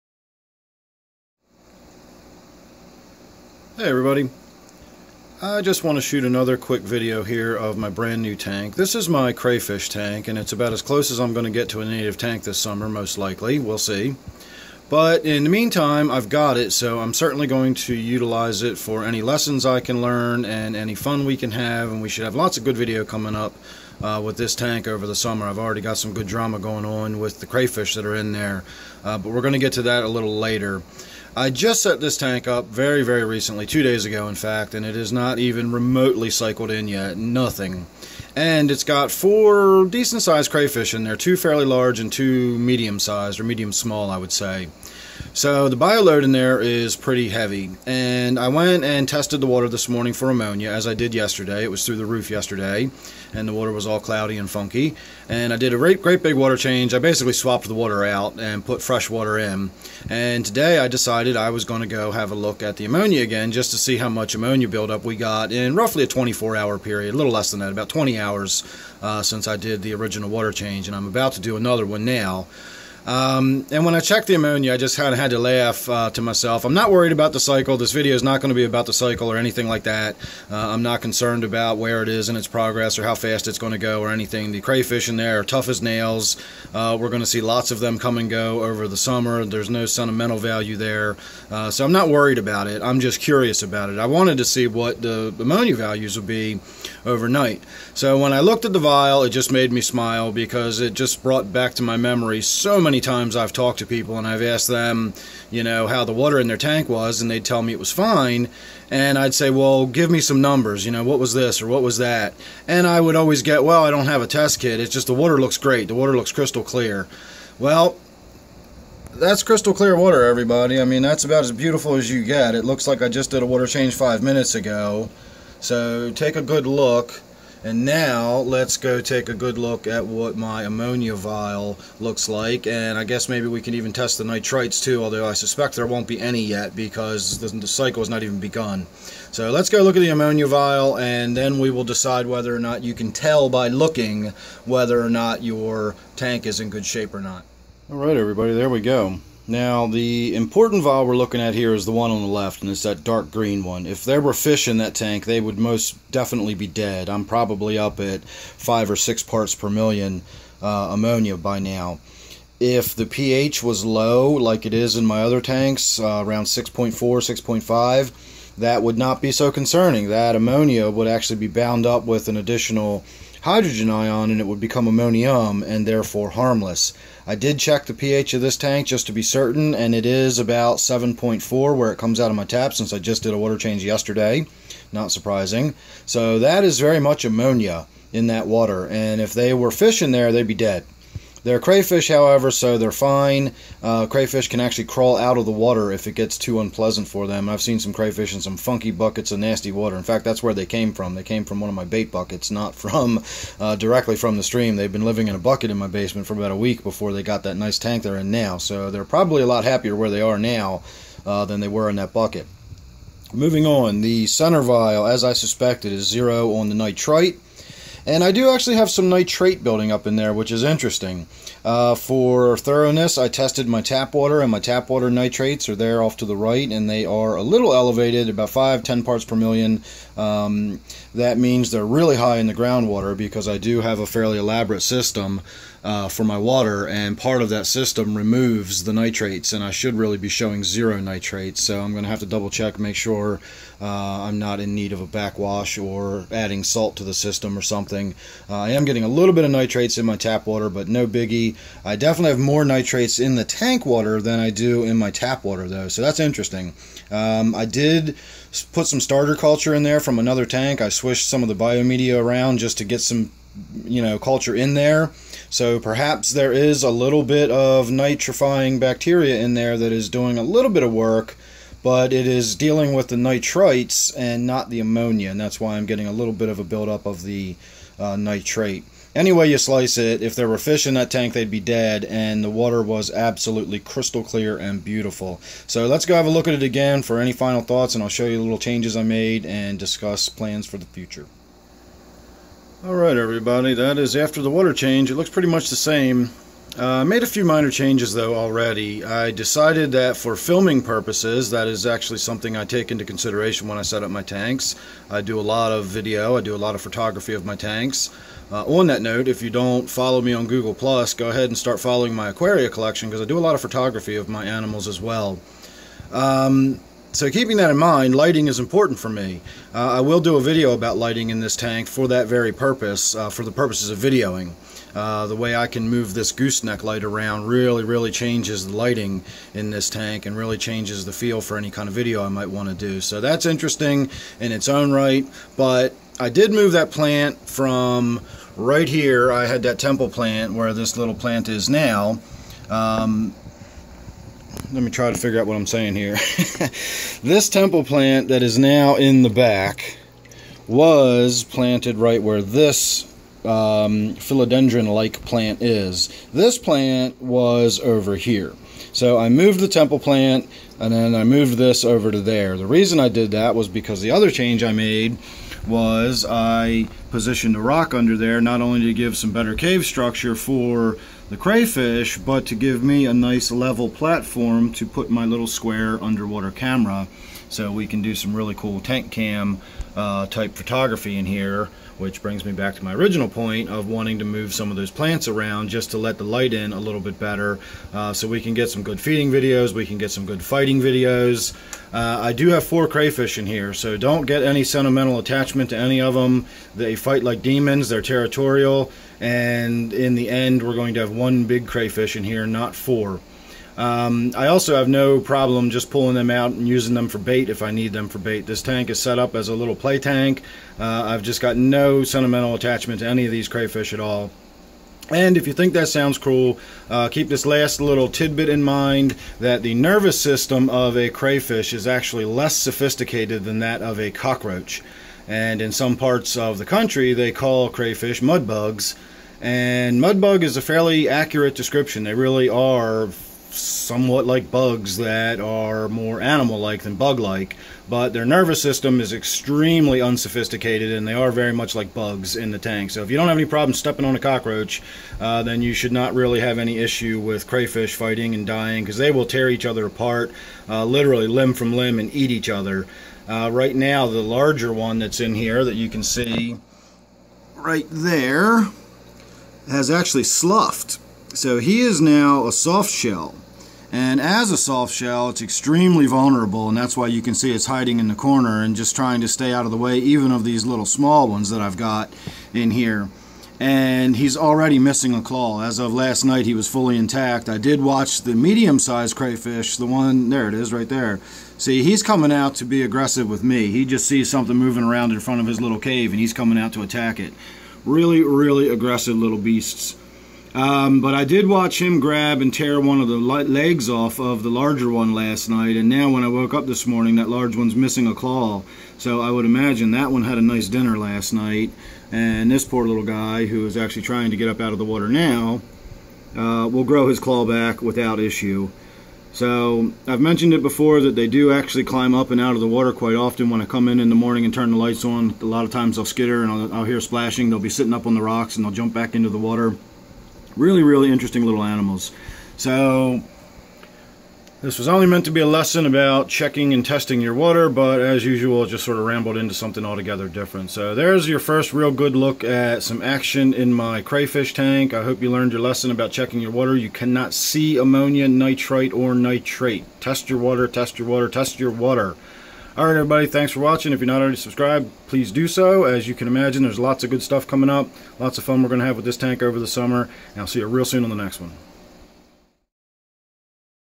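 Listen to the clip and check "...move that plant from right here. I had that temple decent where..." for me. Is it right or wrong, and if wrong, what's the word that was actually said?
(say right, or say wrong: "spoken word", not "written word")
wrong: "plant", not "decent".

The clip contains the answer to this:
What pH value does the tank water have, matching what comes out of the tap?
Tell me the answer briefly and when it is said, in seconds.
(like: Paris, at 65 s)
7.4, at 180 s.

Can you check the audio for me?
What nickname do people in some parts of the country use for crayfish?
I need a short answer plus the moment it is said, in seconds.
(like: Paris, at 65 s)
mudbugs, at 428 s.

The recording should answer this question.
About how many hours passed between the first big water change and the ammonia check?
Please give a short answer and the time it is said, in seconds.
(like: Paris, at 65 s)
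20, at 67 s.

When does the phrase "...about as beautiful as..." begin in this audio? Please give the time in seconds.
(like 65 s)
121 s.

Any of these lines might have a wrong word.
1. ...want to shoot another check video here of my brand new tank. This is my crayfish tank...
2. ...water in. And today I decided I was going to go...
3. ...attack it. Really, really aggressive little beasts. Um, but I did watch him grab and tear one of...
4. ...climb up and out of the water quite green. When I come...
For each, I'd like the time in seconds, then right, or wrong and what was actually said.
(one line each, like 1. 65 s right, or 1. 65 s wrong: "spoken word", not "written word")
1. 5 s wrong: "quick", not "check"
2. 59 s right
3. 486 s right
4. 511 s wrong: "often", not "green".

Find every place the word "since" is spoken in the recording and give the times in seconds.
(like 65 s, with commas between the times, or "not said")
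69 s, 182 s.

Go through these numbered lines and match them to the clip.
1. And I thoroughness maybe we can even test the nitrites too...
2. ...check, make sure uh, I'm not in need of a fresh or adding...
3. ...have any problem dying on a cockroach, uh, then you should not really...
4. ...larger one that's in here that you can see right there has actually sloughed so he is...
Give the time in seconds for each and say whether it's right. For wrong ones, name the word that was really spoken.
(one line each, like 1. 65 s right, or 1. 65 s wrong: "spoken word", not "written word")
1. 132 s wrong: "guess", not "thoroughness"
2. 242 s wrong: "backwash", not "fresh"
3. 443 s wrong: "stepping", not "dying"
4. 454 s right.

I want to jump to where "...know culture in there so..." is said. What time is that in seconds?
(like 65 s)
264 s.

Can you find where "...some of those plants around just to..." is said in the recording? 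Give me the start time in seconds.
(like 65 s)
384 s.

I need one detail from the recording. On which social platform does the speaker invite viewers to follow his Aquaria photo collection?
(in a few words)
Google+.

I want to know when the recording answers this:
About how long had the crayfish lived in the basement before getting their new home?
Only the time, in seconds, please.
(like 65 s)
206 s.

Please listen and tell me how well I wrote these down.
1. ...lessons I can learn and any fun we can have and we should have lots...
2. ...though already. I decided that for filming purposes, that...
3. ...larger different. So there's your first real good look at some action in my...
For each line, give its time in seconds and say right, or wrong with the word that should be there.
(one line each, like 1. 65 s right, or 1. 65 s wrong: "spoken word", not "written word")
1. 19 s right
2. 298 s right
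3. 529 s wrong: "altogether", not "larger".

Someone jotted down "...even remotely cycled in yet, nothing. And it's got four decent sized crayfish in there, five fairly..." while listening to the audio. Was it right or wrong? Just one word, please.
wrong.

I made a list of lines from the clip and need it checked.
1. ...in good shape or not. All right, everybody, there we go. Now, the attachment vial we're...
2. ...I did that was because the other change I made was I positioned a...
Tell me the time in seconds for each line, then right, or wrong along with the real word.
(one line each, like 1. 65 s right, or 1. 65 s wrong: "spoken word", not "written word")
1. 146 s wrong: "important", not "attachment"
2. 362 s right.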